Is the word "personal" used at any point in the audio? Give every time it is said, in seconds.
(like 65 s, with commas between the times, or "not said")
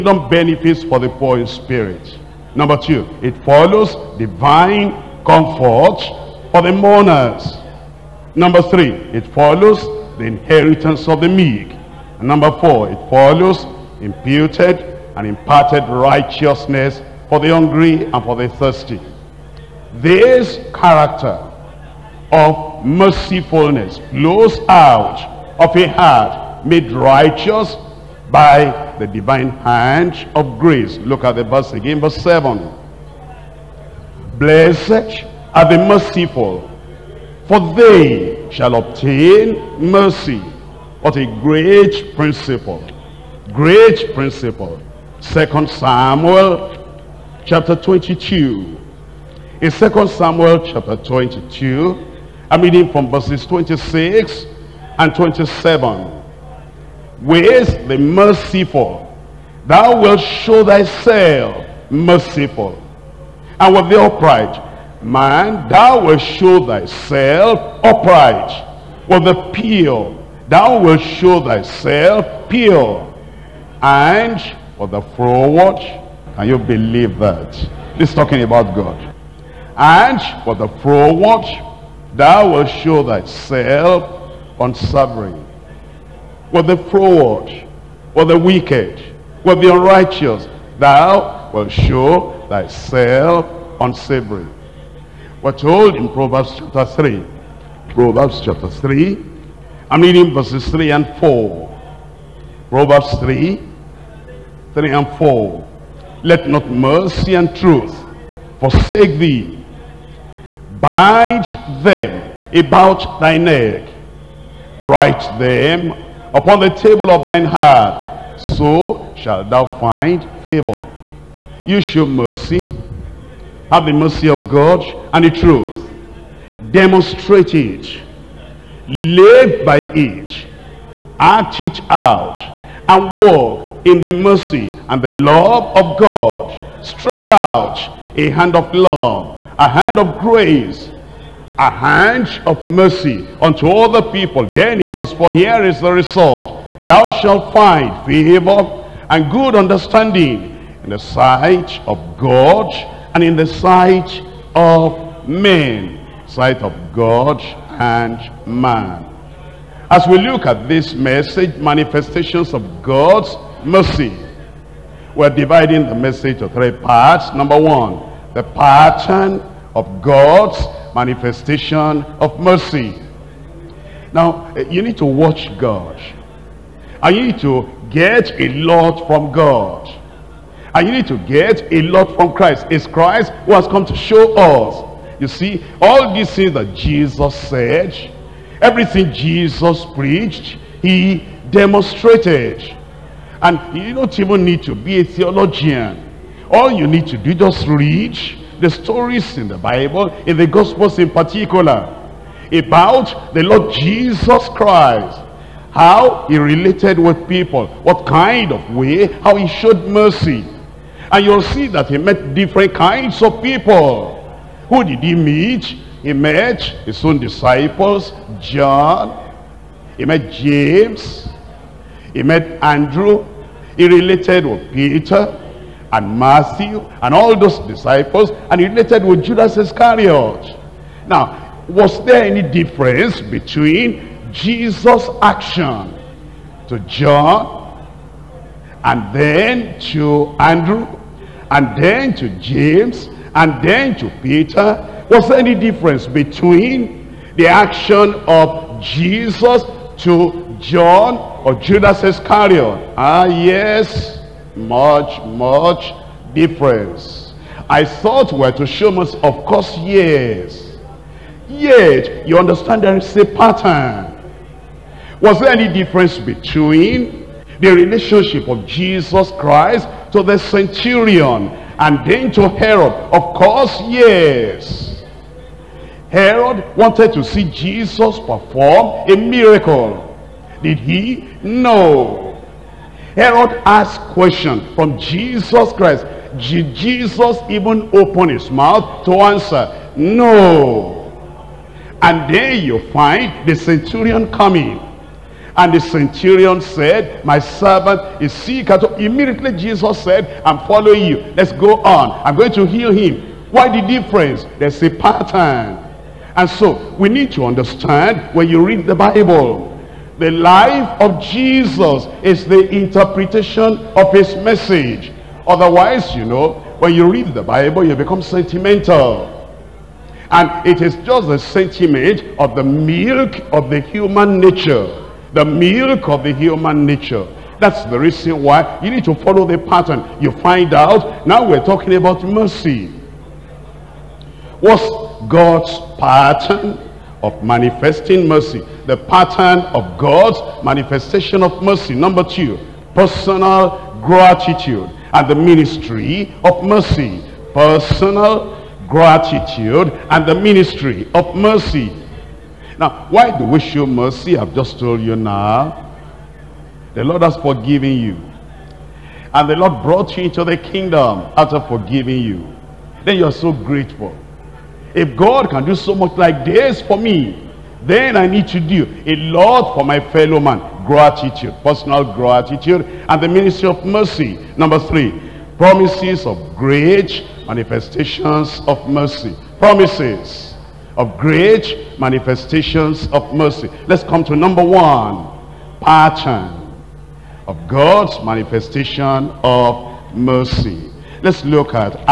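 342 s, 347 s, 371 s.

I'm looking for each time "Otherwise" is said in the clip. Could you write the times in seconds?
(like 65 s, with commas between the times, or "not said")
315 s.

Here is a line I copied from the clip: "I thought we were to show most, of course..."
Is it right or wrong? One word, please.
right.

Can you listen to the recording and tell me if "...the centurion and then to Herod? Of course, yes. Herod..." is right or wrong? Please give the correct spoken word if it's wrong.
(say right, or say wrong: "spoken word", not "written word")
right.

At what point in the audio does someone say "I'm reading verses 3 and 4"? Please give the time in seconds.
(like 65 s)
99 s.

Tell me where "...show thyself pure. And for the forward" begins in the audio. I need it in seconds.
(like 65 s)
71 s.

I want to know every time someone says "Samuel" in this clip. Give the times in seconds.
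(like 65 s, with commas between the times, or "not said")
45 s, 50 s.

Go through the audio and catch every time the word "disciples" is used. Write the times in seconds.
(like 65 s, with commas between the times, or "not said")
217 s, 227 s.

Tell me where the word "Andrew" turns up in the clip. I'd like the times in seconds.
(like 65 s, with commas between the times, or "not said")
222 s, 240 s.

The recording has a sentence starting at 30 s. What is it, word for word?
Look at the verse again, verse 7.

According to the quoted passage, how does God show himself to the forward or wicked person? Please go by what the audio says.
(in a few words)
Unsavoury.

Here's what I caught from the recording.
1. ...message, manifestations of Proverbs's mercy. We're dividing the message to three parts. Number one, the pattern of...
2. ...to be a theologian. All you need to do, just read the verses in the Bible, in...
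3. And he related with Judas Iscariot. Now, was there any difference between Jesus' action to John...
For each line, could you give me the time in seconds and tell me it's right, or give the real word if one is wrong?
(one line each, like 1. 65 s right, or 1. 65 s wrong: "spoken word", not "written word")
1. 160 s wrong: "God", not "Proverbs"
2. 194 s wrong: "stories", not "verses"
3. 228 s right.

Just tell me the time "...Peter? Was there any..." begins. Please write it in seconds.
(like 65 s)
244 s.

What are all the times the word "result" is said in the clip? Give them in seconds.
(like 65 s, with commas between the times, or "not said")
145 s.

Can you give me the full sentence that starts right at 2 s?
Number two, it follows divine comfort for the mourners.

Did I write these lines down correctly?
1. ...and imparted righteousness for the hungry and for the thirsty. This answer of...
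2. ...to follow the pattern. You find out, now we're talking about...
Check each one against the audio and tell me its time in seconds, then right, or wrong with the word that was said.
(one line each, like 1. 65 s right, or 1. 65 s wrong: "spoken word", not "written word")
1. 15 s wrong: "character", not "answer"
2. 329 s right.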